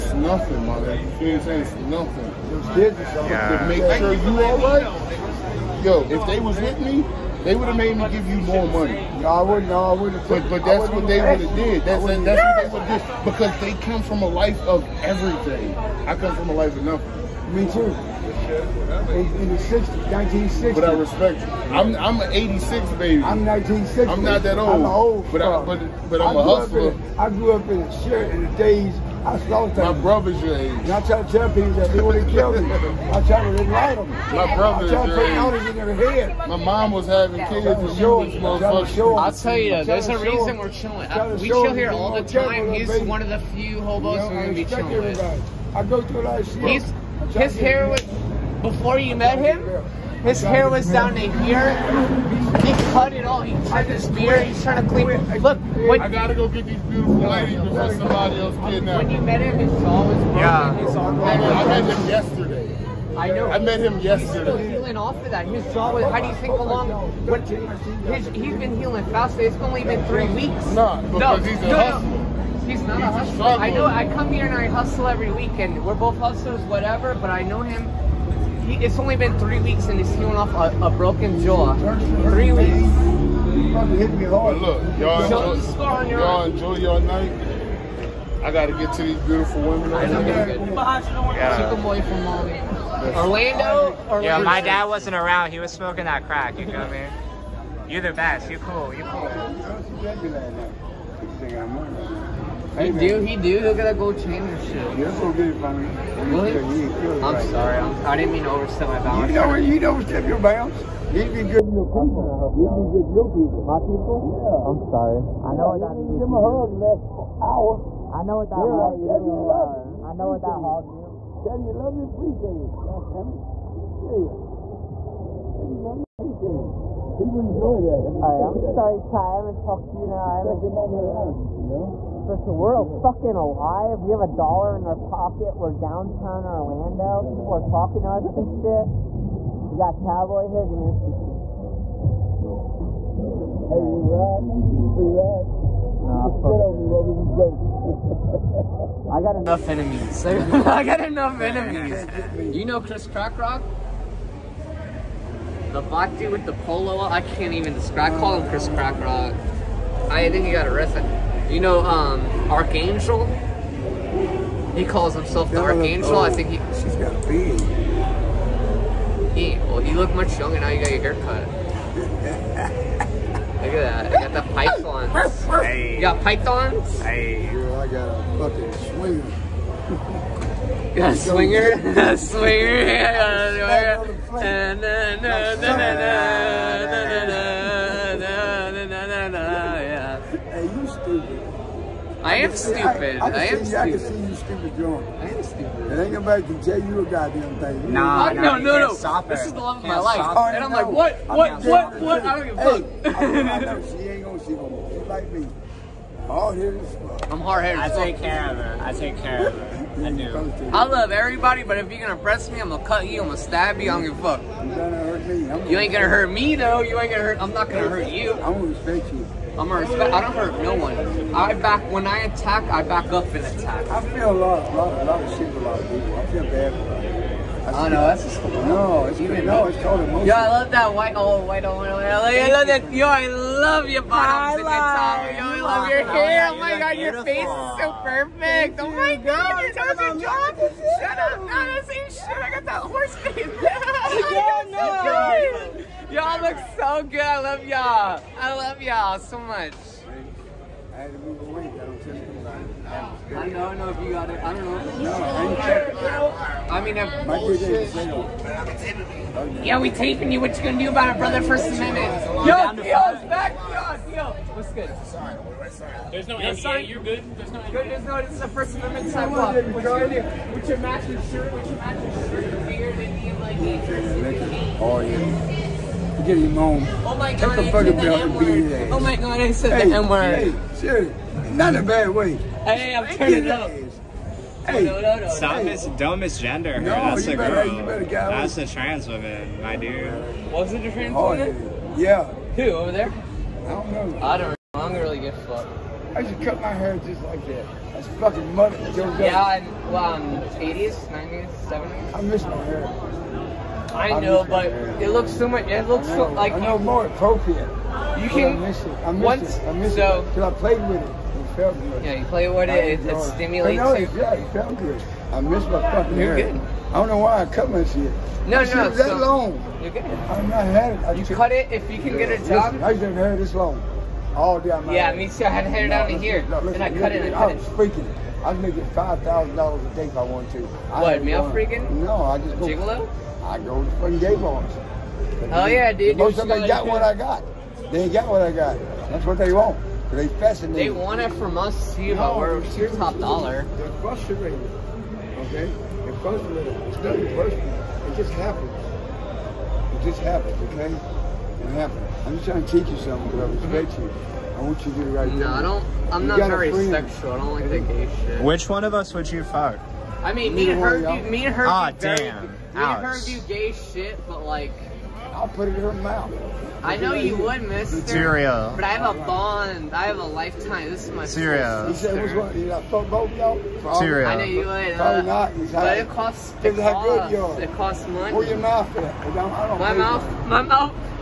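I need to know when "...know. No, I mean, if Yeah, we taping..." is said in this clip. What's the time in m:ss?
4:14.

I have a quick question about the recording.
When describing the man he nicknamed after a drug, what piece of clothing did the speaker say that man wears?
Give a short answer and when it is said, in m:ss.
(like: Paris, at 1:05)
polo, at 2:36.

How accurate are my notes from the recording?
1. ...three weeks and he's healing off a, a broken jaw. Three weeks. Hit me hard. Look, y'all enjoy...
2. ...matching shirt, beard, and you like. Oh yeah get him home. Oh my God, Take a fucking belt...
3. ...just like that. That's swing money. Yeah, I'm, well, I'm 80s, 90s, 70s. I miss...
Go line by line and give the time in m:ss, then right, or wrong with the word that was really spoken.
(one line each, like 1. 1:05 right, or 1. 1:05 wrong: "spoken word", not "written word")
1. 1:19 right
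2. 4:31 right
3. 4:56 wrong: "fucking", not "swing".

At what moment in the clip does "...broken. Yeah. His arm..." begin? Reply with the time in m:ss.
1:00.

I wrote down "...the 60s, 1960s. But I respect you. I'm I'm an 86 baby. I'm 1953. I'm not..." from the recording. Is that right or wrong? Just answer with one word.
wrong.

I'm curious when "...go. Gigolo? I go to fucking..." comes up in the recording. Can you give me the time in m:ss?
5:32.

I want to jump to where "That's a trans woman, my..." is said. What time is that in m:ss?
4:48.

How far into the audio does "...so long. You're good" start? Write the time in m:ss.
5:18.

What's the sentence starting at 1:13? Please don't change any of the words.
I come here and I hustle every weekend.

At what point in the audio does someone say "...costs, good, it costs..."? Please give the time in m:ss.
6:16.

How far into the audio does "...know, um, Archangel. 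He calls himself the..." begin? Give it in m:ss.
2:41.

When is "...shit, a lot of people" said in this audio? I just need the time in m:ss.
3:45.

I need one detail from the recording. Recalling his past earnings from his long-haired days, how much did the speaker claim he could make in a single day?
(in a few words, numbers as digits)
$5,000.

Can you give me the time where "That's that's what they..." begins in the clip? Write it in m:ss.
0:11.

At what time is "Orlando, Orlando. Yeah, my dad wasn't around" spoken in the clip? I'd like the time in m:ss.
1:33.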